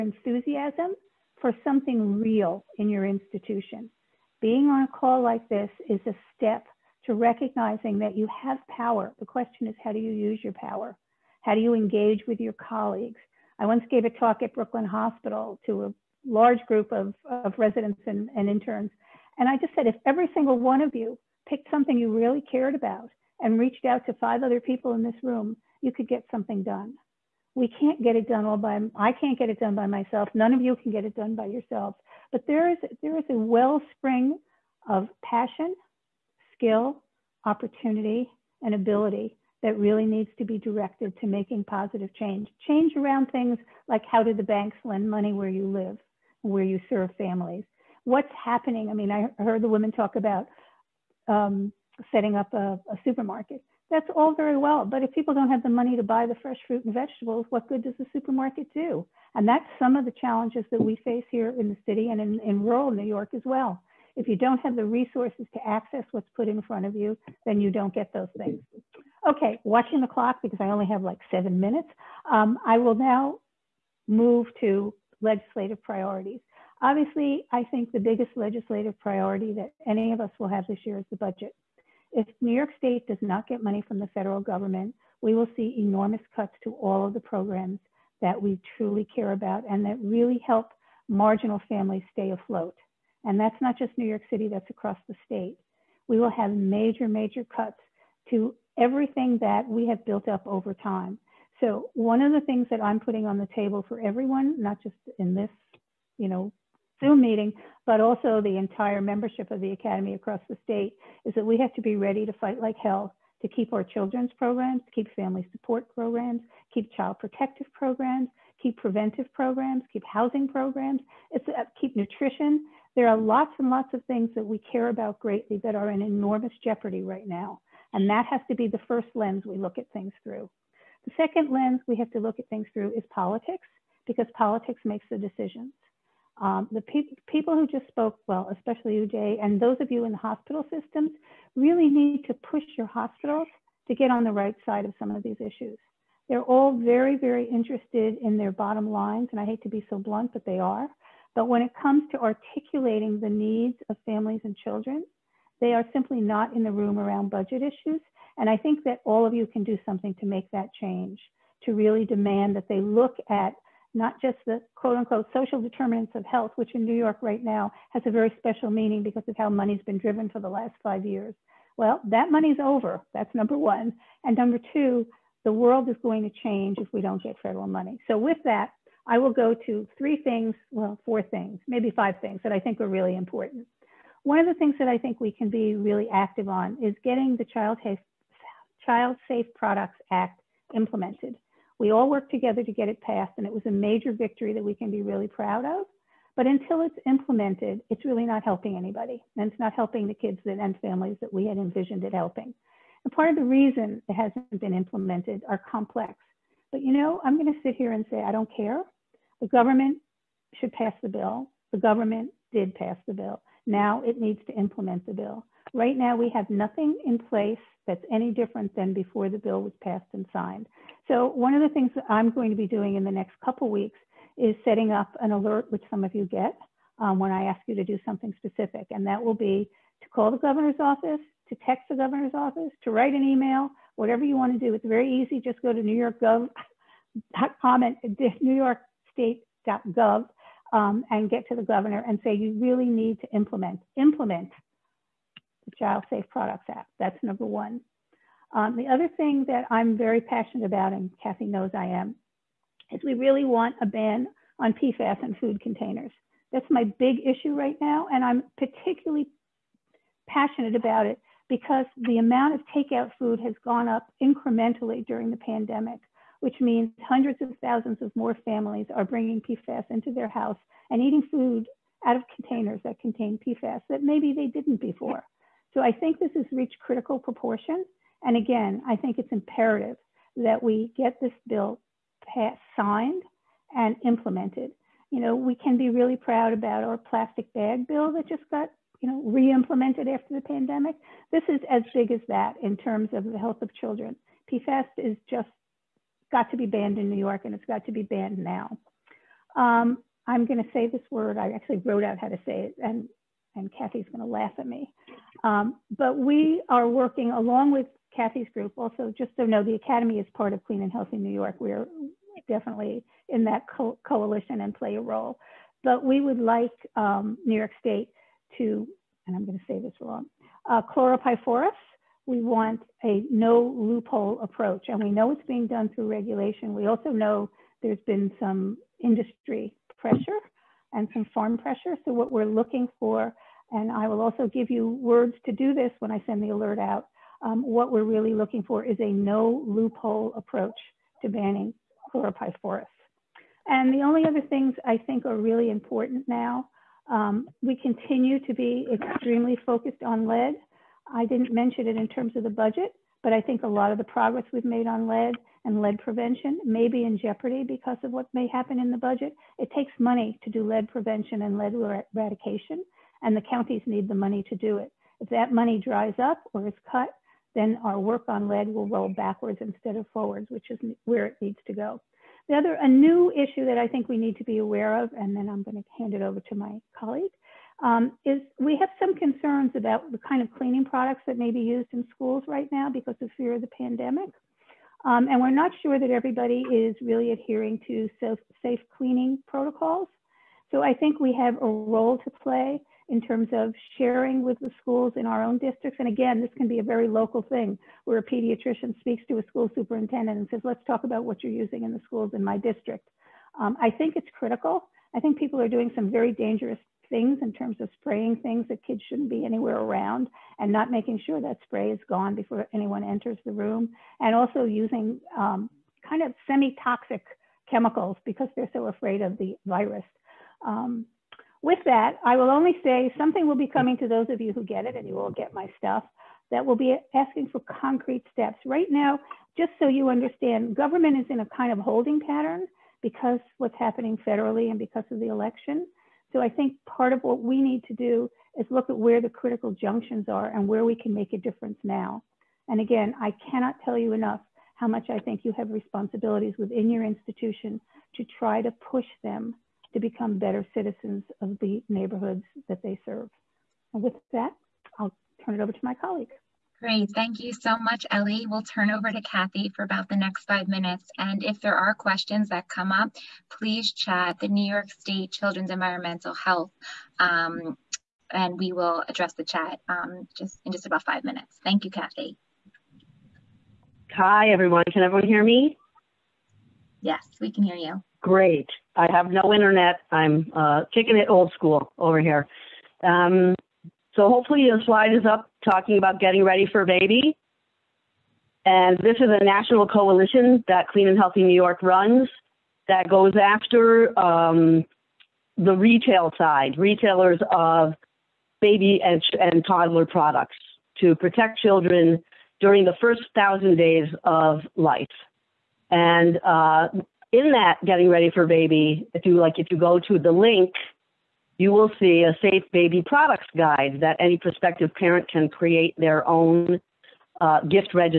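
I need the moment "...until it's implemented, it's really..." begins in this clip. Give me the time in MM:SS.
03:16.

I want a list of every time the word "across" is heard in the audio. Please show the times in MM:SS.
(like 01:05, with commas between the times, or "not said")
01:34, 01:50.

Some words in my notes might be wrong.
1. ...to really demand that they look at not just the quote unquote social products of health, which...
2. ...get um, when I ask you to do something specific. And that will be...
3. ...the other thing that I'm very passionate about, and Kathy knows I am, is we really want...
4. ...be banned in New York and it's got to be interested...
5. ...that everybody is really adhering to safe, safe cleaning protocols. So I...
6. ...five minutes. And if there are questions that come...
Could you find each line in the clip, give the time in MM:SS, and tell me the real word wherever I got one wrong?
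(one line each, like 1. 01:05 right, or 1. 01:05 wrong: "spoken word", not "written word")
1. 02:41 wrong: "determinants", not "products"
2. 03:46 right
3. 04:08 right
4. 04:56 wrong: "banned", not "interested"
5. 06:25 right
6. 07:40 right.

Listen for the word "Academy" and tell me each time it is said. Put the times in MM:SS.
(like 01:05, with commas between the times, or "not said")
01:49, 05:09.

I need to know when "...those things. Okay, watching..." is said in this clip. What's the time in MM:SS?
01:08.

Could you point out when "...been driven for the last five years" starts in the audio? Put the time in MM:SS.
02:49.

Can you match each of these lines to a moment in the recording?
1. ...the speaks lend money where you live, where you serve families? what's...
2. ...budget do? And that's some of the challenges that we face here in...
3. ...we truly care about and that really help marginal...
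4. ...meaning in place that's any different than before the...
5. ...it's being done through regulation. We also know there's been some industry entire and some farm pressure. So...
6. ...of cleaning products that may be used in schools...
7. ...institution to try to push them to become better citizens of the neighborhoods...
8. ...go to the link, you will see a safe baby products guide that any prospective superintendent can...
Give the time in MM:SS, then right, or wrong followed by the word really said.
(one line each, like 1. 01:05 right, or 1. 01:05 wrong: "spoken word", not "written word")
1. 00:44 wrong: "banks", not "speaks"
2. 00:58 wrong: "supermarket", not "budget"
3. 01:28 right
4. 03:36 wrong: "nothing", not "meaning"
5. 05:25 wrong: "pressure", not "entire"
6. 06:20 right
7. 07:27 right
8. 08:29 wrong: "parent", not "superintendent".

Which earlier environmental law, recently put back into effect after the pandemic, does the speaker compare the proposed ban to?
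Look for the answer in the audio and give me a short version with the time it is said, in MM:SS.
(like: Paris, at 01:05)
plastic bag bill, at 04:46.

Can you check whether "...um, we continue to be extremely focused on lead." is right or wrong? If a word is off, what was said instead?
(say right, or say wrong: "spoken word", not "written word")
right.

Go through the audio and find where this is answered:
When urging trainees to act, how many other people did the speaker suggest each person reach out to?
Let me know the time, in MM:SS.
00:24.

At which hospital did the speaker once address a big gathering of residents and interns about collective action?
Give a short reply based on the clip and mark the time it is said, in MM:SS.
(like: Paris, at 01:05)
Brooklyn Hospital, at 00:14.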